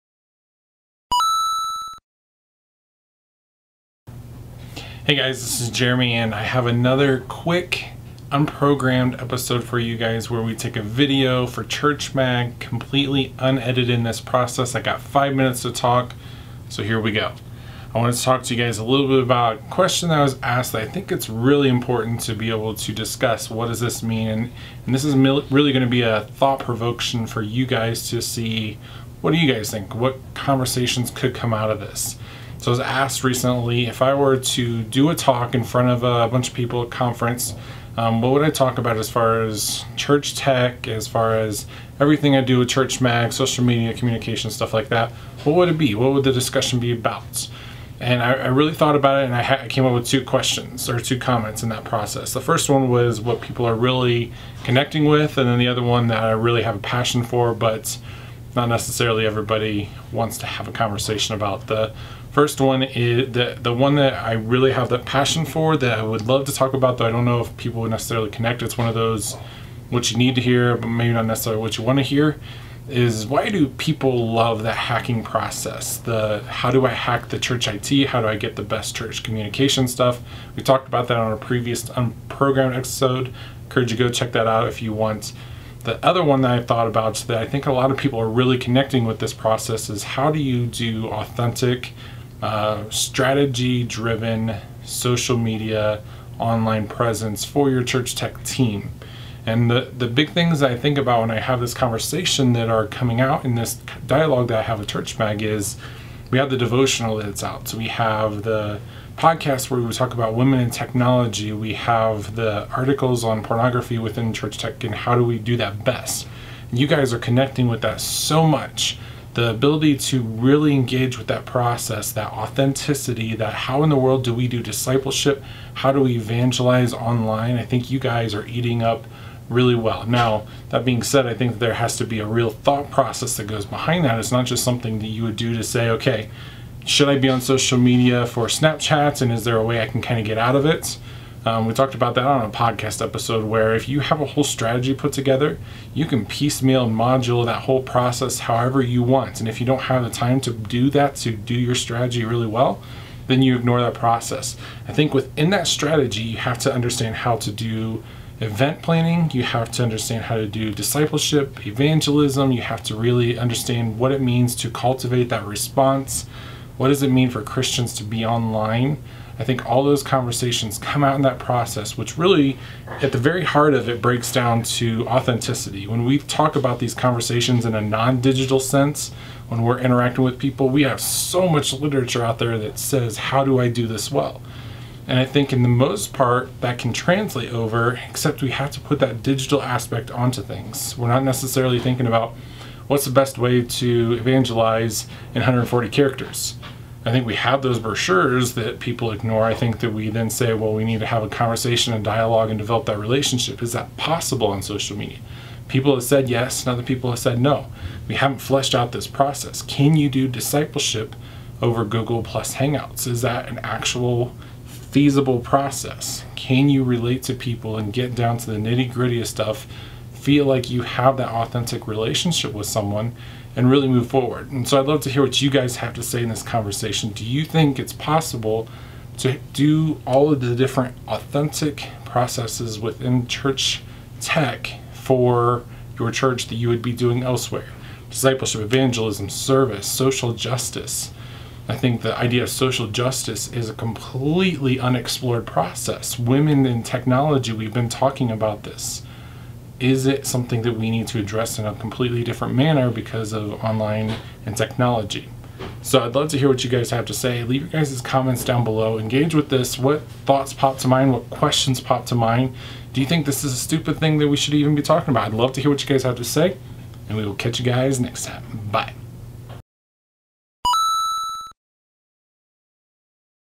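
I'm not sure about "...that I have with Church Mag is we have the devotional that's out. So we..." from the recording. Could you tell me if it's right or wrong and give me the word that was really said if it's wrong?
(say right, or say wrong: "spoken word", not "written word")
right.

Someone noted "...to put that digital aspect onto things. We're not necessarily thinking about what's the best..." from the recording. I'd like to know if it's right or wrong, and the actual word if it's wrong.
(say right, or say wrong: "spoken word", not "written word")
right.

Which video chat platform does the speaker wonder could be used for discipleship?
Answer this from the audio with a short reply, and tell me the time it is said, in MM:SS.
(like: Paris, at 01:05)
Google Plus Hangouts, at 03:31.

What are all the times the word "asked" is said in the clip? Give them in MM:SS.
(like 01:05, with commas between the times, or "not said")
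00:20, 00:32.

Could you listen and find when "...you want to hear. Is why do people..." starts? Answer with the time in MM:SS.
01:11.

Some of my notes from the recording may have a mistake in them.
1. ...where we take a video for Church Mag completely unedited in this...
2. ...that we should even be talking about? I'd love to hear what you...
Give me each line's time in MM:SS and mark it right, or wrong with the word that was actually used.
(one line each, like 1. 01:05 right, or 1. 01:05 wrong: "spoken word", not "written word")
1. 00:10 right
2. 04:24 right.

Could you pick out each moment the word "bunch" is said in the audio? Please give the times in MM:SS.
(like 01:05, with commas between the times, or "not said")
00:36.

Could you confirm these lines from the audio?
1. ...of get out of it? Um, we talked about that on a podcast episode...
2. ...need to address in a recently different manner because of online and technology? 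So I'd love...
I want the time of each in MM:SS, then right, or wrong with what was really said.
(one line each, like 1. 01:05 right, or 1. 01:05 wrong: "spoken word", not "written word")
1. 02:20 right
2. 04:10 wrong: "completely", not "recently".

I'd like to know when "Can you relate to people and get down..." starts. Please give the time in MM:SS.
03:36.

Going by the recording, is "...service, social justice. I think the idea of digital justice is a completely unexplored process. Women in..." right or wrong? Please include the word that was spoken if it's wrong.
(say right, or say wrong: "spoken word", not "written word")
wrong: "social", not "digital".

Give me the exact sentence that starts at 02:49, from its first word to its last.
I think all those conversations come out in that process, which really, at the very heart of it, breaks down to authenticity.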